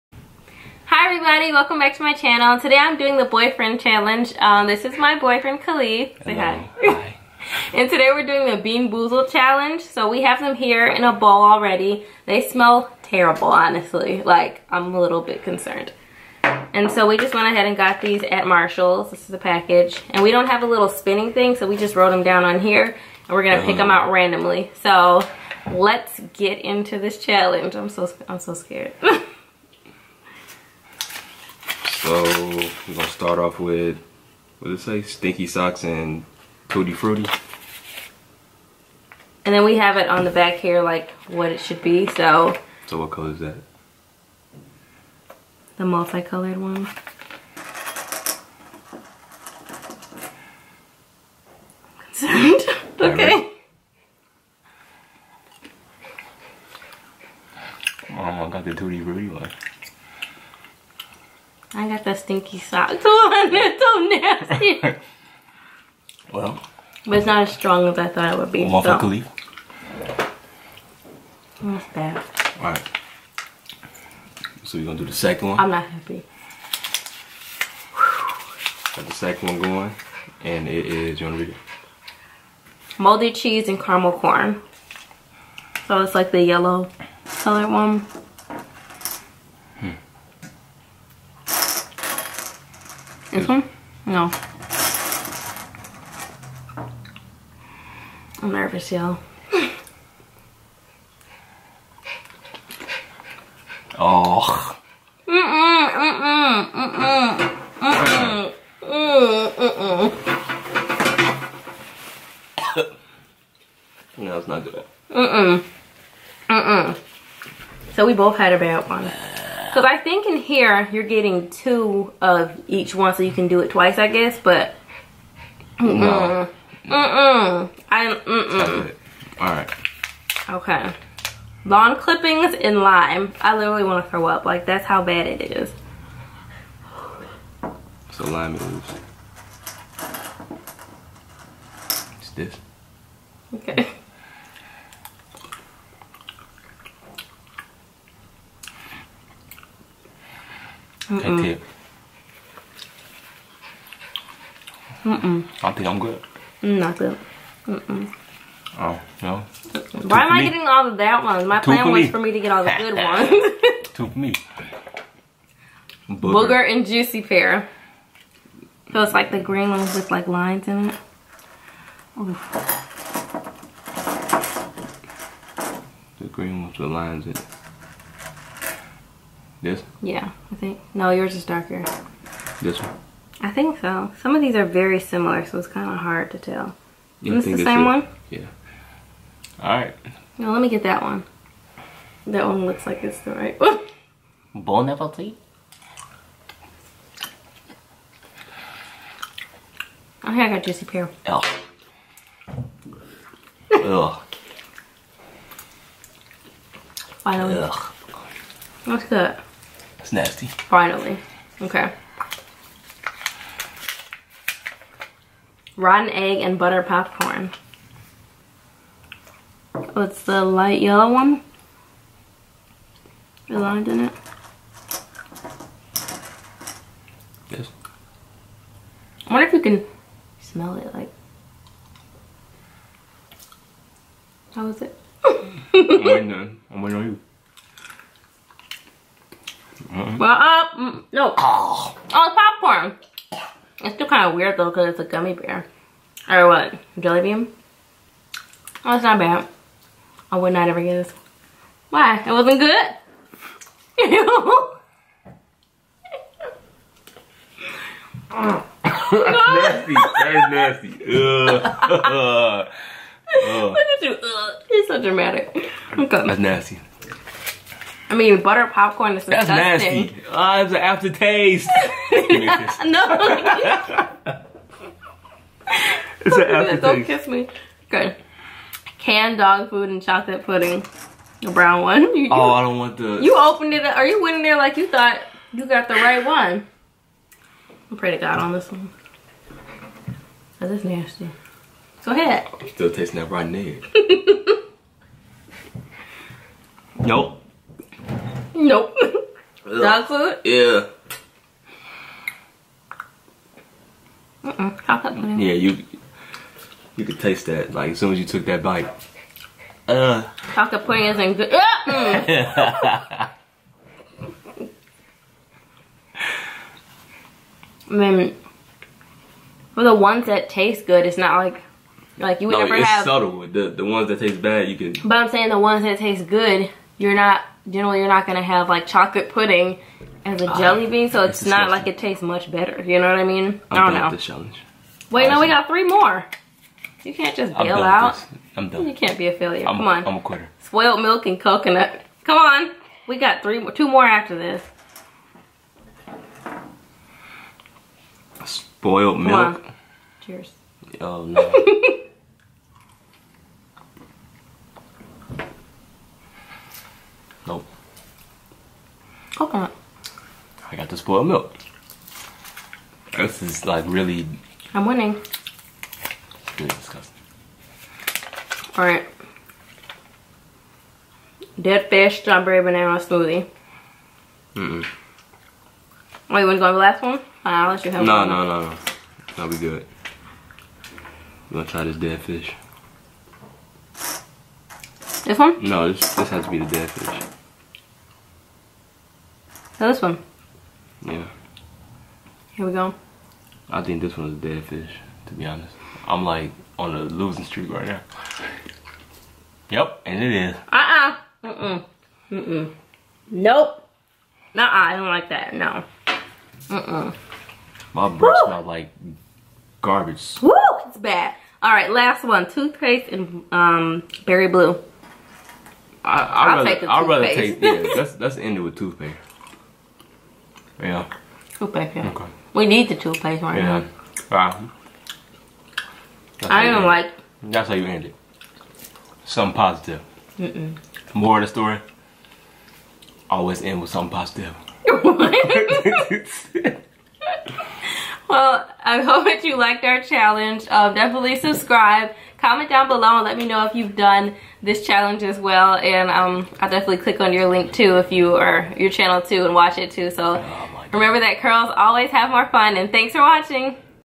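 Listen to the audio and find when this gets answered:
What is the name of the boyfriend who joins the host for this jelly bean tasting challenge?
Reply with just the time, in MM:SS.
00:05.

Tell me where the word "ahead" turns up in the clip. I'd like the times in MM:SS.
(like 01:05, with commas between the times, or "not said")
00:17, 04:52.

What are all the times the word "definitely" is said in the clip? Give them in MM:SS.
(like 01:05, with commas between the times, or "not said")
07:20, 07:26.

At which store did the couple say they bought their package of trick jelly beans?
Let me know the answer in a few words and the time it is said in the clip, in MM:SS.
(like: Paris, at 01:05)
Marshalls, at 00:18.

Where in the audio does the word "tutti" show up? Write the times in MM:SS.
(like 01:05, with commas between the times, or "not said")
00:36, 00:58.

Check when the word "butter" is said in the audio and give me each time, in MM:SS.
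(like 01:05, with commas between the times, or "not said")
03:36, 04:28.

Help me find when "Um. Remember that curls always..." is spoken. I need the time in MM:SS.
07:30.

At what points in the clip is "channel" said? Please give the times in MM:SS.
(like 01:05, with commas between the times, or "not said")
00:02, 07:28.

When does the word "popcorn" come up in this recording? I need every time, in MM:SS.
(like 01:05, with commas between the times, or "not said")
03:36, 04:02, 04:28.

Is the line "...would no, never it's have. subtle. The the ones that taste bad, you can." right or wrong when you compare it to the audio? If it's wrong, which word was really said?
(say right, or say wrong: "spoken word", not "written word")
right.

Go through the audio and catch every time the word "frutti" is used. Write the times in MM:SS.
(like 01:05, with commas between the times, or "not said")
00:36, 00:59.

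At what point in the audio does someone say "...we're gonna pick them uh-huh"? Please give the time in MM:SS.
00:23.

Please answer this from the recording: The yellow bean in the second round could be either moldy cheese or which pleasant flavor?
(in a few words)
Caramel corn.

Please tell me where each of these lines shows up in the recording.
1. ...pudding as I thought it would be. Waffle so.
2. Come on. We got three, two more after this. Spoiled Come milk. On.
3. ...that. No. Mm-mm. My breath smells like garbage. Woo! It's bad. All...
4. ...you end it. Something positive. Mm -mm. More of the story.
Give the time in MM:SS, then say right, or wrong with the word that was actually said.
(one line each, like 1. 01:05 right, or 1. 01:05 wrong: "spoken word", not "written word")
1. 01:07 wrong: "strong", not "pudding"
2. 05:42 right
3. 06:45 right
4. 07:07 right.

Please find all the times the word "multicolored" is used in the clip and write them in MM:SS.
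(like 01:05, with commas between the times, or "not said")
00:45.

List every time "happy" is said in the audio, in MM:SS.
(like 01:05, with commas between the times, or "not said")
01:15.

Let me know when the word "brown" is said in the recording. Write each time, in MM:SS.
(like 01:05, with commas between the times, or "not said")
04:41.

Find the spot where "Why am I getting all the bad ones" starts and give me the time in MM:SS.
02:40.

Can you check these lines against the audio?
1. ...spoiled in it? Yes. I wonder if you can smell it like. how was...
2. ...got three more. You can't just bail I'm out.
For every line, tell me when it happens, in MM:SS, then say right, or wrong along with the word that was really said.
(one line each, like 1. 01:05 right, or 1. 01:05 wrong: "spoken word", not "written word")
1. 03:43 wrong: "lined", not "spoiled"
2. 05:35 right.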